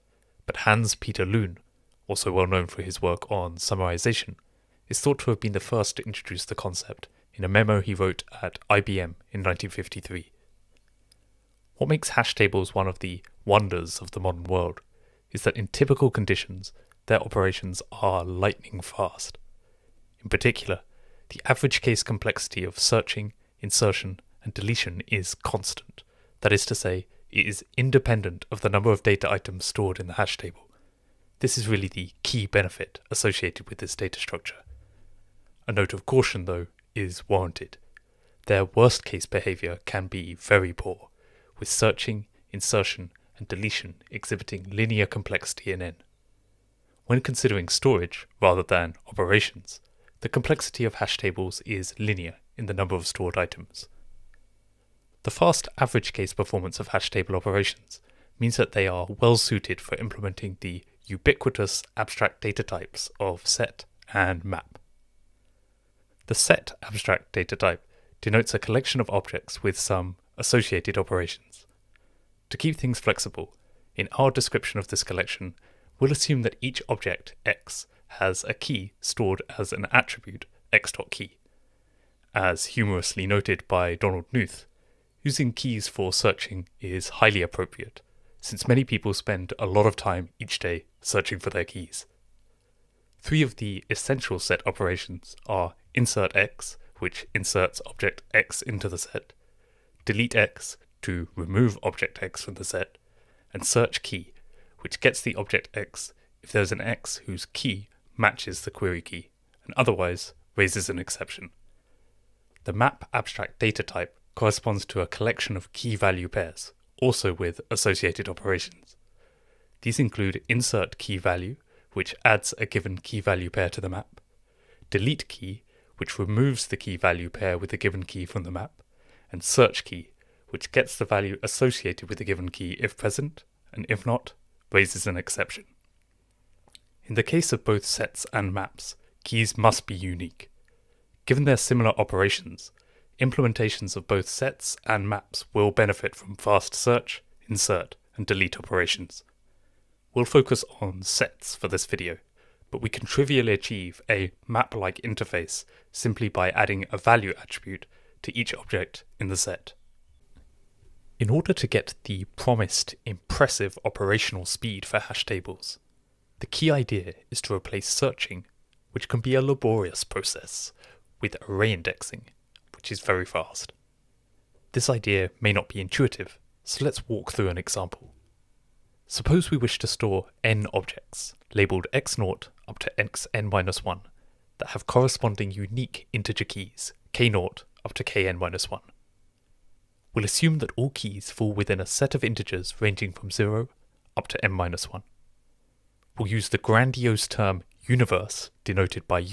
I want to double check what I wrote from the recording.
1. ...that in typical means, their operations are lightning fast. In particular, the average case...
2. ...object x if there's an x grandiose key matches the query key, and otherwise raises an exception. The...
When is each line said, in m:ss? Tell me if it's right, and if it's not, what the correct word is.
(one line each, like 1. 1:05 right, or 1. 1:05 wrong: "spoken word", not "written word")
1. 0:15 wrong: "conditions", not "means"
2. 1:45 wrong: "whose", not "grandiose".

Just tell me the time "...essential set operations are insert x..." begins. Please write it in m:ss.
1:33.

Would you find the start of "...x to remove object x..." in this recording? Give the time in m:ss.
1:40.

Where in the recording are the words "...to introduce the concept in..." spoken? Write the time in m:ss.
0:05.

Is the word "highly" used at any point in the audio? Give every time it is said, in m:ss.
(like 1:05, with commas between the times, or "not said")
1:27.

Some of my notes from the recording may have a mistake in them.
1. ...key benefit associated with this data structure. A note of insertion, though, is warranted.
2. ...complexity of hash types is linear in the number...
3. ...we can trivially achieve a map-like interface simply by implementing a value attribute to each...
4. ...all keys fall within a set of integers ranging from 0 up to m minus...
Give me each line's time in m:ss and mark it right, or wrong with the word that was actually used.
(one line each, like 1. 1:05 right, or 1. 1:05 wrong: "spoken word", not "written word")
1. 0:32 wrong: "caution", not "insertion"
2. 0:50 wrong: "tables", not "types"
3. 2:32 wrong: "adding", not "implementing"
4. 3:10 right.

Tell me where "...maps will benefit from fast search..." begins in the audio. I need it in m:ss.
2:25.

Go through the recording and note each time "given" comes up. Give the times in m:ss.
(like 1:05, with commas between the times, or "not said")
2:02, 2:07, 2:12, 2:21.